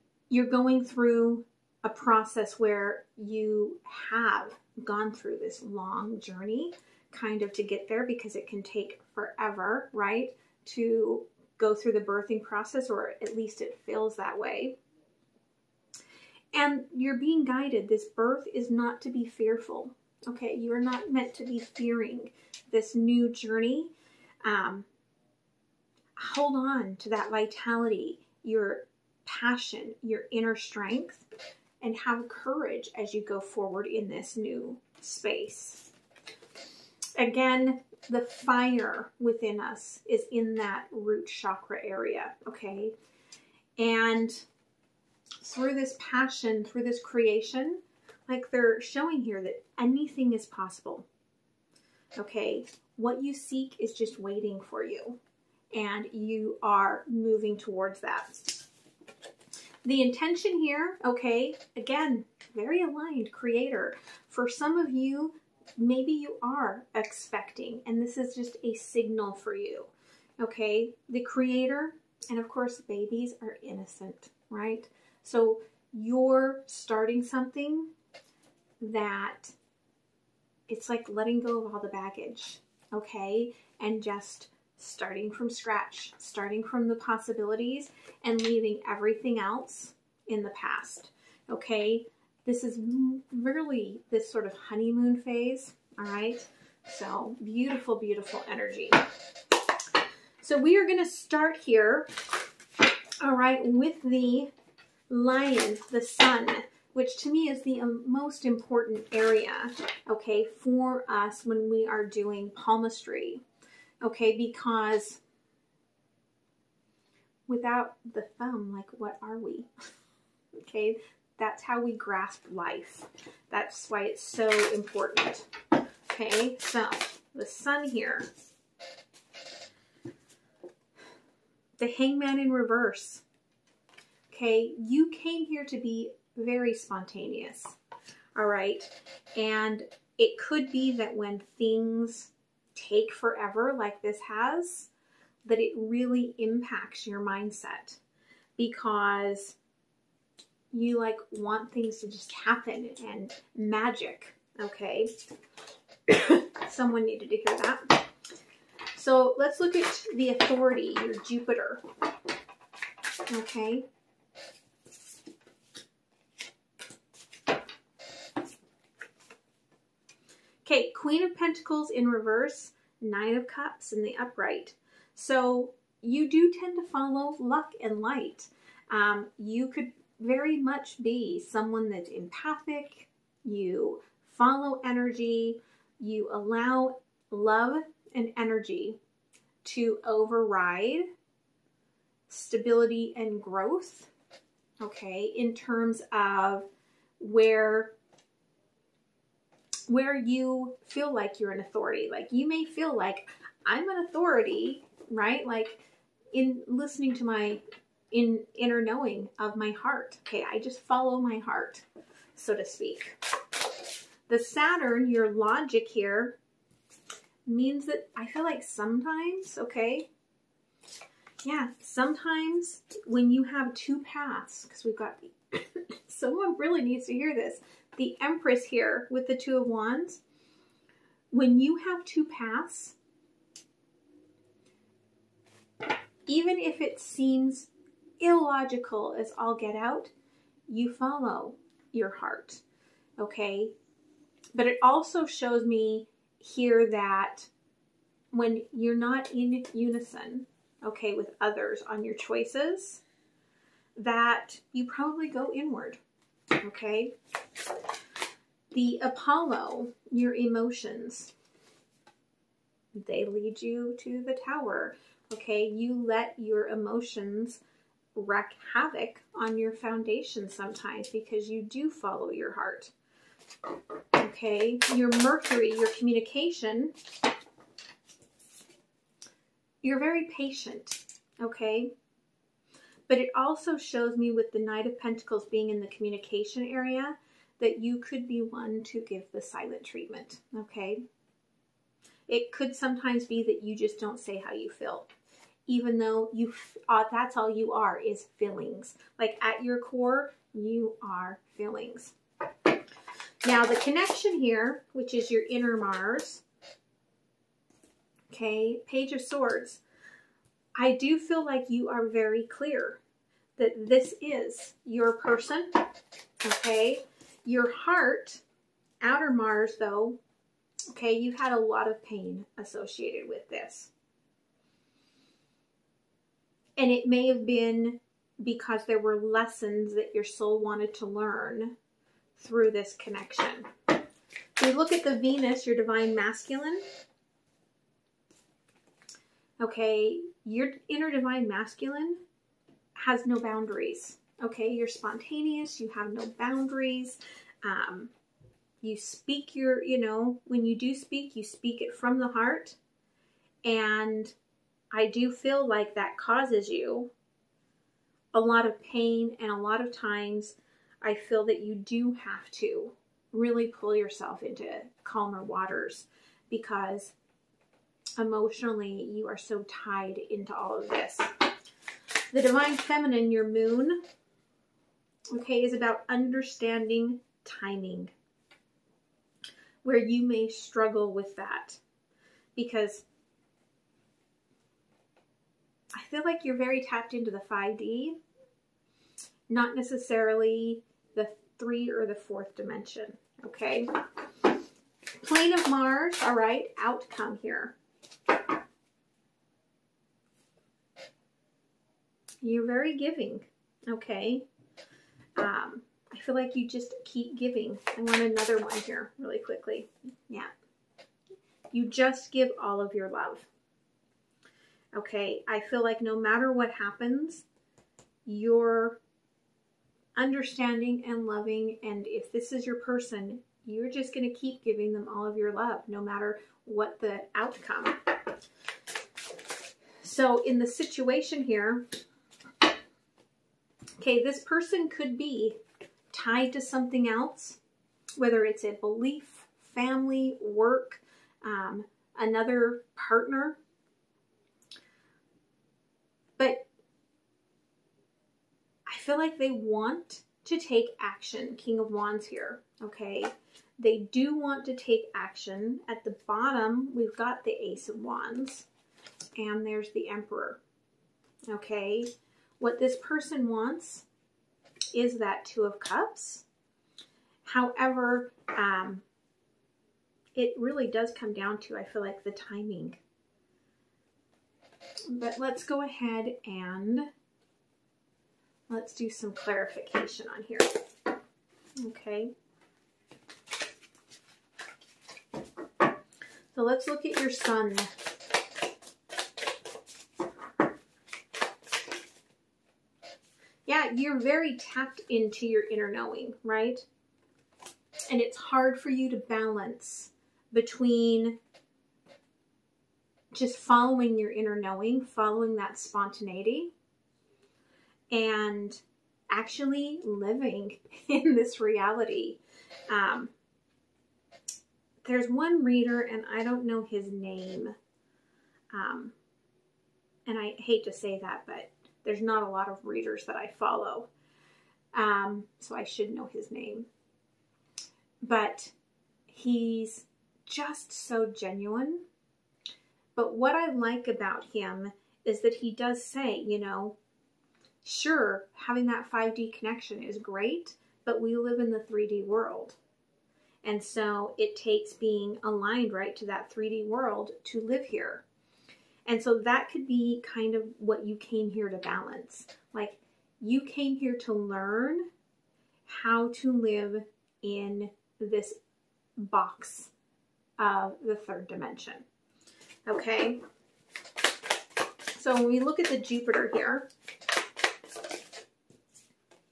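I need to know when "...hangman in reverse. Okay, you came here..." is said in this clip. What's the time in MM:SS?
02:11.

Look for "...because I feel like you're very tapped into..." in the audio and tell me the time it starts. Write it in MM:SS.
06:22.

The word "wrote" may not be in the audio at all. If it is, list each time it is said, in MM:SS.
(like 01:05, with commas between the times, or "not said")
not said.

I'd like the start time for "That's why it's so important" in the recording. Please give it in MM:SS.
02:03.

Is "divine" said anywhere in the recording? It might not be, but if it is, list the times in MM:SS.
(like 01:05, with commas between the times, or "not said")
05:35, 05:41, 06:12.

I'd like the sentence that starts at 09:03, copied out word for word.
And so it takes being aligned right to that 3D world to live here.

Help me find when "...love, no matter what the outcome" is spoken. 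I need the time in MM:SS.
07:05.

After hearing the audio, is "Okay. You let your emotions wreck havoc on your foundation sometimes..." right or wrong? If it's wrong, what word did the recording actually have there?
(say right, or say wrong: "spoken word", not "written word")
right.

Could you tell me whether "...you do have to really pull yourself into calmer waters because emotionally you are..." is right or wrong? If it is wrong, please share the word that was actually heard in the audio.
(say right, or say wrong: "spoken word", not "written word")
right.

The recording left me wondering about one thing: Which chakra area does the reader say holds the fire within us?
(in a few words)
Root chakra.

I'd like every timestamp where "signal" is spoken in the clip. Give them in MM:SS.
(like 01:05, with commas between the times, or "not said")
01:08.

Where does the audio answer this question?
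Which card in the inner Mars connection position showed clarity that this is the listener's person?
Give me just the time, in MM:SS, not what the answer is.
05:08.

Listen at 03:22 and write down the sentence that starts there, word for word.
Like you may feel like I'm an authority, right?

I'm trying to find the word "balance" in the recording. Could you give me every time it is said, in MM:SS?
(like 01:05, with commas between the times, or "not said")
08:19, 09:11.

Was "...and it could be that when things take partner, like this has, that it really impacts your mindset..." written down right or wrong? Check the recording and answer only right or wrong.
wrong.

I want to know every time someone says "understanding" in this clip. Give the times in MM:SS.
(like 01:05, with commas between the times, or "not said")
06:16, 07:00.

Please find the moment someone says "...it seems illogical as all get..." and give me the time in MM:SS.
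03:56.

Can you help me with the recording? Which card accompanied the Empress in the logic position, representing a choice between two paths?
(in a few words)
Two of Wands.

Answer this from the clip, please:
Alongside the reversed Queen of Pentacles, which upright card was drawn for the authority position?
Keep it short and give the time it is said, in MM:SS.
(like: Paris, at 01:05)
Nine of Cups, at 02:53.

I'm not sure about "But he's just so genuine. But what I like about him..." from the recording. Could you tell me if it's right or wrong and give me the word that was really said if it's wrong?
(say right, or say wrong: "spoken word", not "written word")
right.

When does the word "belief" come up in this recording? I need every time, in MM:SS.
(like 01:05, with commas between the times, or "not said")
07:18.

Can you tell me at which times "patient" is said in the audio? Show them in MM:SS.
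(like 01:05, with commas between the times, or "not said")
04:40.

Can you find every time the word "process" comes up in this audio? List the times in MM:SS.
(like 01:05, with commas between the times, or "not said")
00:01, 00:12.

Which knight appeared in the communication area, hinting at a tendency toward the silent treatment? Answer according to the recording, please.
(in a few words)
Knight of Pentacles.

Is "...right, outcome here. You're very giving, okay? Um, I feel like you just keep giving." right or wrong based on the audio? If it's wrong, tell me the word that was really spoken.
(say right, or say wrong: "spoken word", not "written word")
right.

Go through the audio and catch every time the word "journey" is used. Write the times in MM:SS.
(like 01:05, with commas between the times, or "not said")
00:06, 00:23.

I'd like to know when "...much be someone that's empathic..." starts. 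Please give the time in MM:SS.
03:00.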